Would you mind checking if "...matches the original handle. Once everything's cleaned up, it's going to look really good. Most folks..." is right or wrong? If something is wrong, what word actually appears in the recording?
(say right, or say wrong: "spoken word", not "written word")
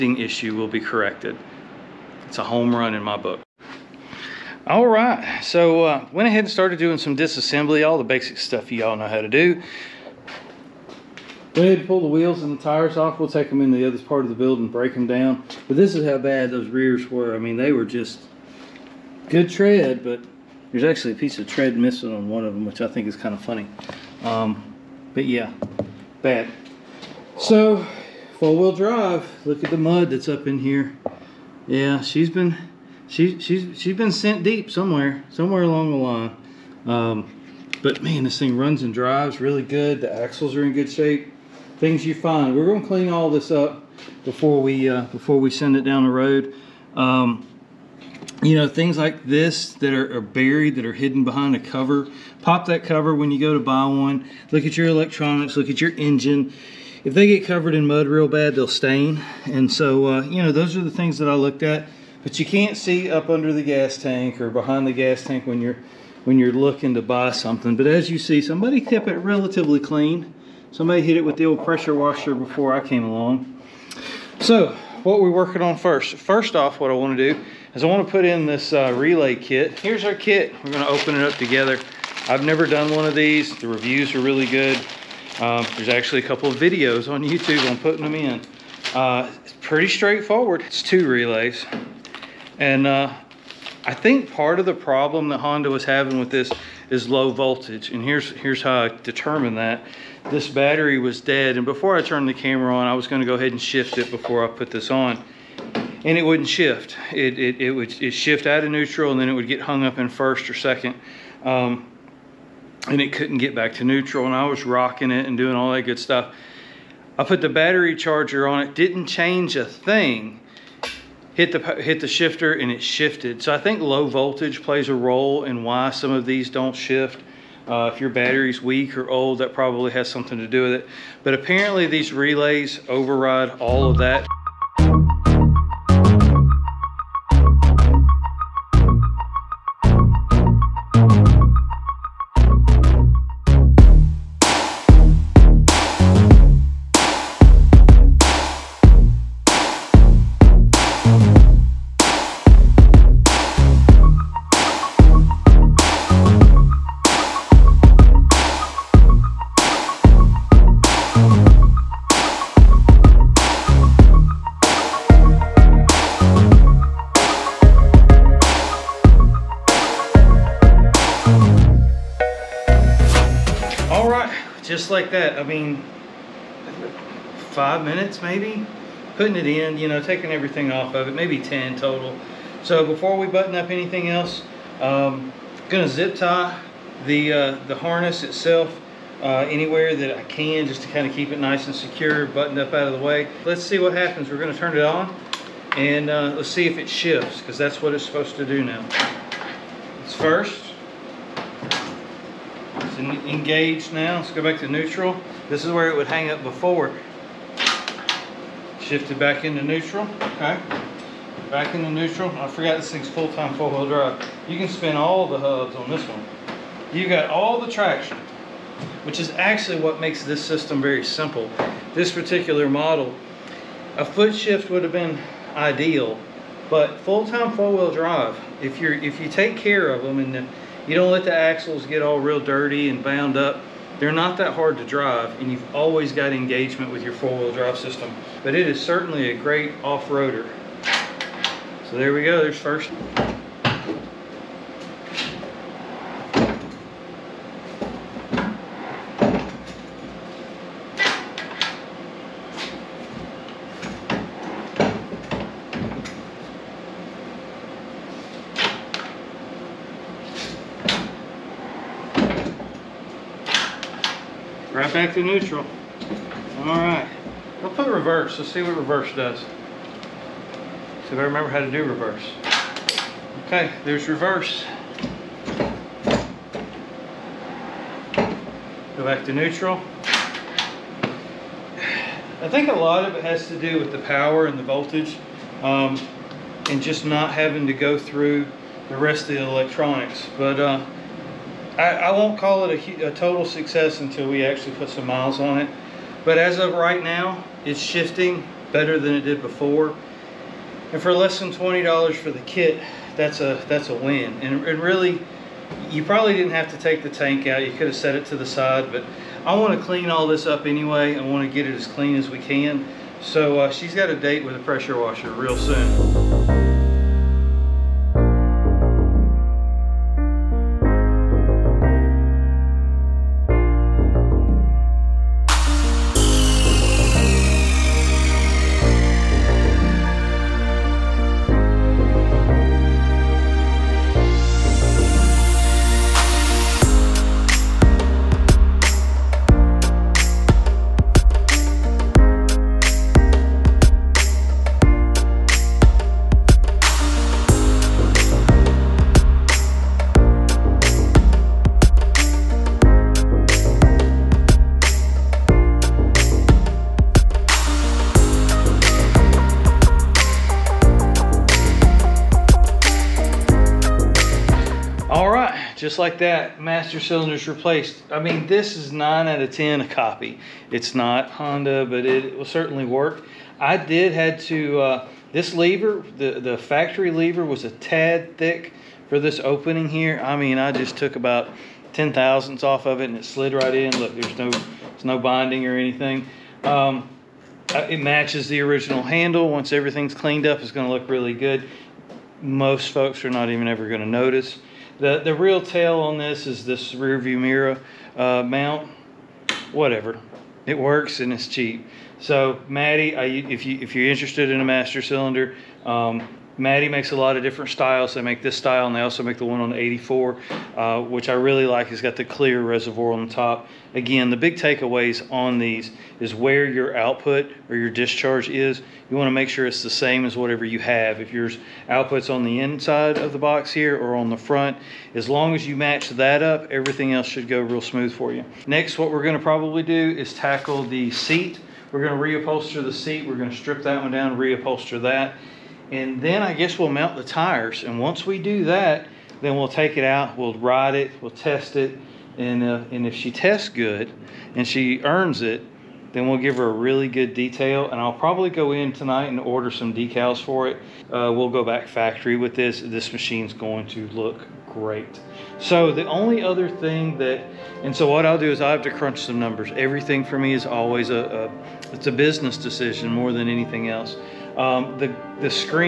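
right.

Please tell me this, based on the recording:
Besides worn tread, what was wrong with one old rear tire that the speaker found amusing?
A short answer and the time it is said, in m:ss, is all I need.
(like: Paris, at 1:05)
A piece of tread missing, at 0:21.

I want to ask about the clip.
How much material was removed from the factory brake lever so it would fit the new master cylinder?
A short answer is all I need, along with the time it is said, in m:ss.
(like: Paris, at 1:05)
10 thousandths, at 6:21.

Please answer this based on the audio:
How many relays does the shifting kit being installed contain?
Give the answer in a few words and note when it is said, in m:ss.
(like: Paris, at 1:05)
2, at 1:30.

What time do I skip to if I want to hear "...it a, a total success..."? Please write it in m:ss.
4:52.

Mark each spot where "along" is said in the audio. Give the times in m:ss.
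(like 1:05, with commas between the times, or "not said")
0:35, 1:13.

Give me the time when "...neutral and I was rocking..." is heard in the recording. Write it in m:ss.
1:53.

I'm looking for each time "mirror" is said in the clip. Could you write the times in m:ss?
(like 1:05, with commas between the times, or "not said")
6:37.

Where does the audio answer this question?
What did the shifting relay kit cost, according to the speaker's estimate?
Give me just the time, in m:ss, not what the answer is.
5:01.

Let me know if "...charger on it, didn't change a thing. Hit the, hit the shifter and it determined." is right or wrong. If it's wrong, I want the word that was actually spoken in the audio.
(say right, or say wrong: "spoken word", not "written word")
wrong: "shifted", not "determined".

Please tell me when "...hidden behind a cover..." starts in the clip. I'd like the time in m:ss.
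0:50.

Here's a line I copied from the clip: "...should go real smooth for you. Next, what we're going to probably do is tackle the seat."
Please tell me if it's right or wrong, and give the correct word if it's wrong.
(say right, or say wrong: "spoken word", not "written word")
right.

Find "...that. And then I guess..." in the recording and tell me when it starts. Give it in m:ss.
7:15.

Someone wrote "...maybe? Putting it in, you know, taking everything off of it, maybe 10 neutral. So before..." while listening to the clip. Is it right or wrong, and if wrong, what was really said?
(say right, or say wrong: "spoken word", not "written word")
wrong: "total", not "neutral".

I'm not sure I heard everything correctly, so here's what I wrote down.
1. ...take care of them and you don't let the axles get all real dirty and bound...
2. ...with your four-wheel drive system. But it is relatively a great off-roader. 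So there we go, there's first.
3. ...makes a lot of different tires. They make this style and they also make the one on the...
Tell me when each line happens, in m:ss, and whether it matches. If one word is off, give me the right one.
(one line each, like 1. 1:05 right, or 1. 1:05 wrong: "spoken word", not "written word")
1. 3:49 right
2. 3:56 wrong: "certainly", not "relatively"
3. 6:46 wrong: "styles", not "tires".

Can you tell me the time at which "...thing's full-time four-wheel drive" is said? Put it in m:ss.
3:32.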